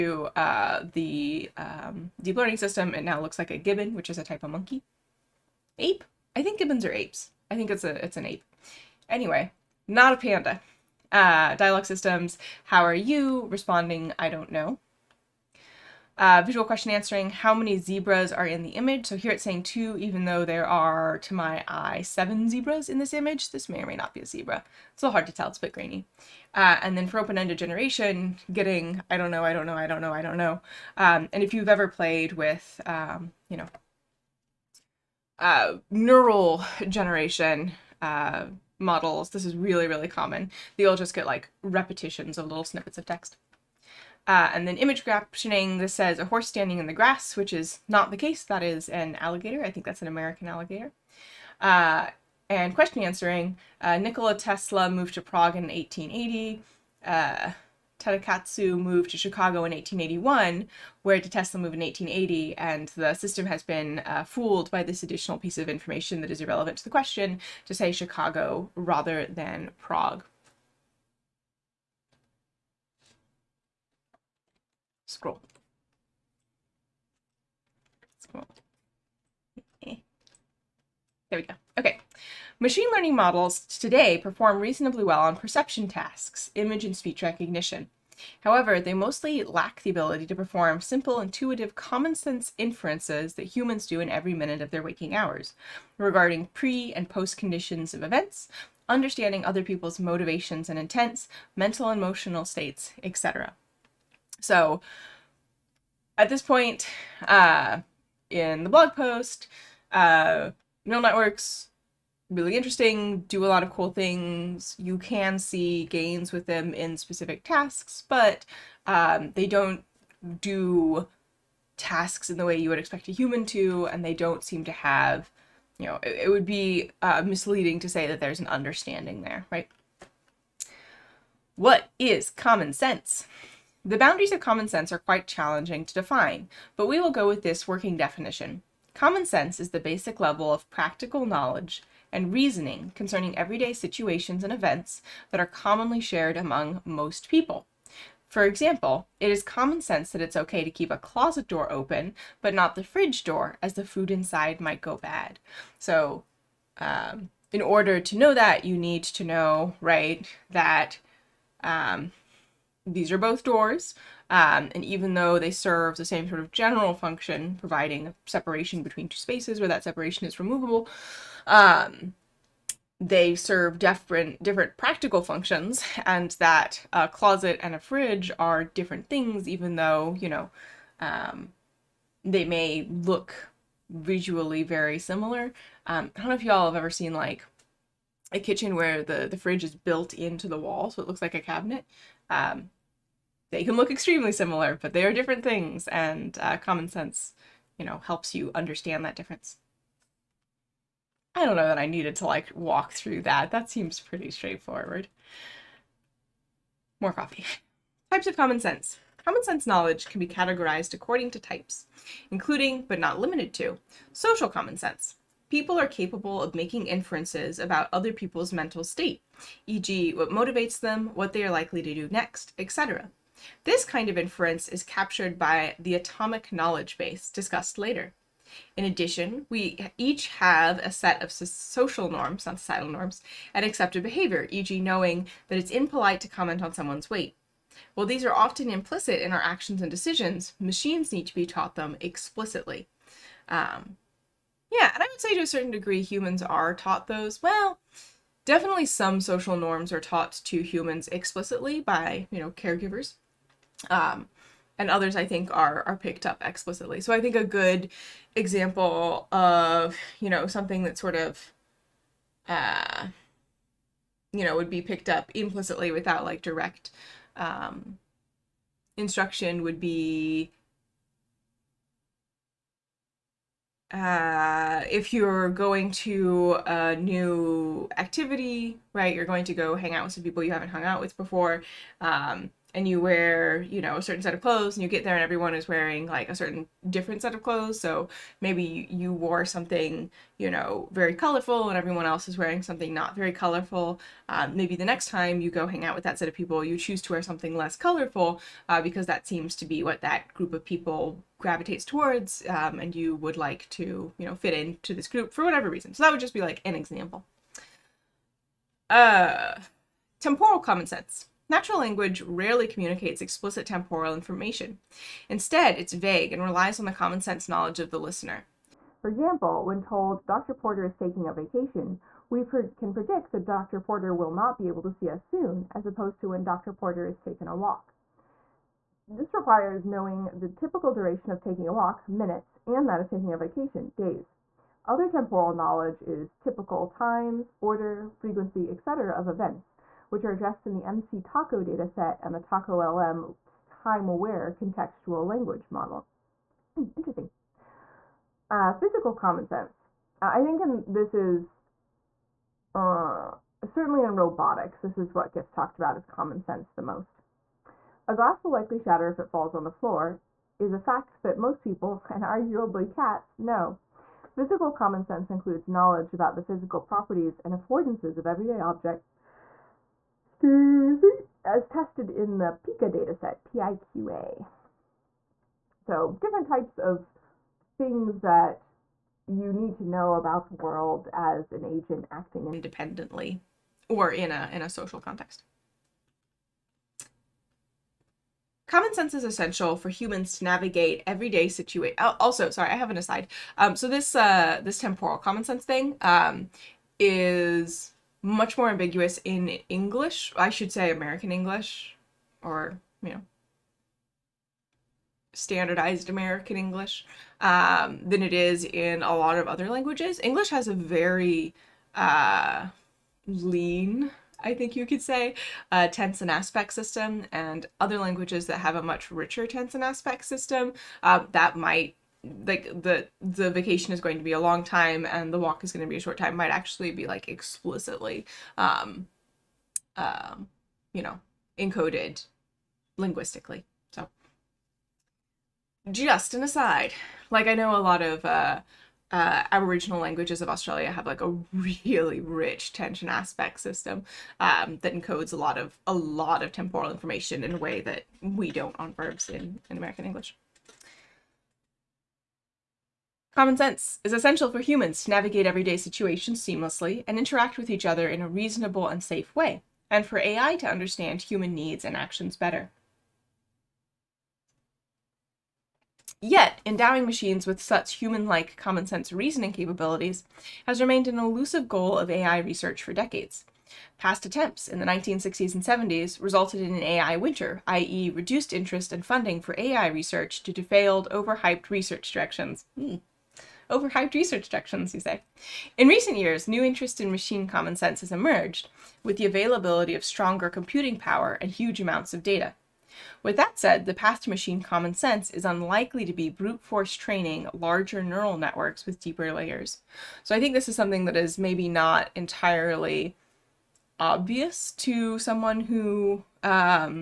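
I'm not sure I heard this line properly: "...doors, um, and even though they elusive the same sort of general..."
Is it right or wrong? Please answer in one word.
wrong.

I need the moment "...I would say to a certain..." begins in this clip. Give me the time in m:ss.
4:05.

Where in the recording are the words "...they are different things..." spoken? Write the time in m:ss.
3:14.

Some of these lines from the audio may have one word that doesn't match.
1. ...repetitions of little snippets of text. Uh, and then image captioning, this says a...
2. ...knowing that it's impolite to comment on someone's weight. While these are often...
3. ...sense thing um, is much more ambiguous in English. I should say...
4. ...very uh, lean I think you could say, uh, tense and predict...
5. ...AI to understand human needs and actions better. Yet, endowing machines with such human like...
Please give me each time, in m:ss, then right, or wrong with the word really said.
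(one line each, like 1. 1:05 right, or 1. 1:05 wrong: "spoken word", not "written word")
1. 0:41 right
2. 3:54 right
3. 6:35 right
4. 6:50 wrong: "aspect", not "predict"
5. 7:40 right.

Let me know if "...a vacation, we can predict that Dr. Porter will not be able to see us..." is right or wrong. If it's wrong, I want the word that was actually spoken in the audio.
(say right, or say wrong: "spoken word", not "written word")
right.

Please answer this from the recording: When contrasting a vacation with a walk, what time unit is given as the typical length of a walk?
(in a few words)
minutes.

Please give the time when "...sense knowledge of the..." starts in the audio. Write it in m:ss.
5:17.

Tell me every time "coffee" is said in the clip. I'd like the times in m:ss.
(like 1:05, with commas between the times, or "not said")
3:27.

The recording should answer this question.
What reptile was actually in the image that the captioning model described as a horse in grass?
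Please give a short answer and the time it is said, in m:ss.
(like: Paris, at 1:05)
American alligator, at 0:50.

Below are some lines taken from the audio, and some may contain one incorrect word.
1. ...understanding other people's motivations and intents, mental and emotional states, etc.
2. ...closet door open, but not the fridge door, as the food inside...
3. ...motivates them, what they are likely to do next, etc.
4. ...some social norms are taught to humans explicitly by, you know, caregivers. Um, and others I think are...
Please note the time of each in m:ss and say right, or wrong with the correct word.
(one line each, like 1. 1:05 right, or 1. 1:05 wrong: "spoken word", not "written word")
1. 1:38 right
2. 2:30 right
3. 3:40 right
4. 4:08 right.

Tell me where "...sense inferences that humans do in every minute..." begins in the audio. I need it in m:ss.
1:32.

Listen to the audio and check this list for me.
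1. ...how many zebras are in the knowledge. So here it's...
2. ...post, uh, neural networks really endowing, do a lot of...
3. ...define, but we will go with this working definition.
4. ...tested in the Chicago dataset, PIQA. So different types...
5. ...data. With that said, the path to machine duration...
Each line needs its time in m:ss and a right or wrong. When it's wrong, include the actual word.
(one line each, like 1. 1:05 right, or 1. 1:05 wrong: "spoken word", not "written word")
1. 0:17 wrong: "image", not "knowledge"
2. 1:48 wrong: "interesting", not "endowing"
3. 2:15 right
4. 6:11 wrong: "PICA", not "Chicago"
5. 8:12 wrong: "common", not "duration".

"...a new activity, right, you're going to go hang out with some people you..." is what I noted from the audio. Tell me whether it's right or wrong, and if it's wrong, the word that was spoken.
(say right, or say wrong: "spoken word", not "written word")
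right.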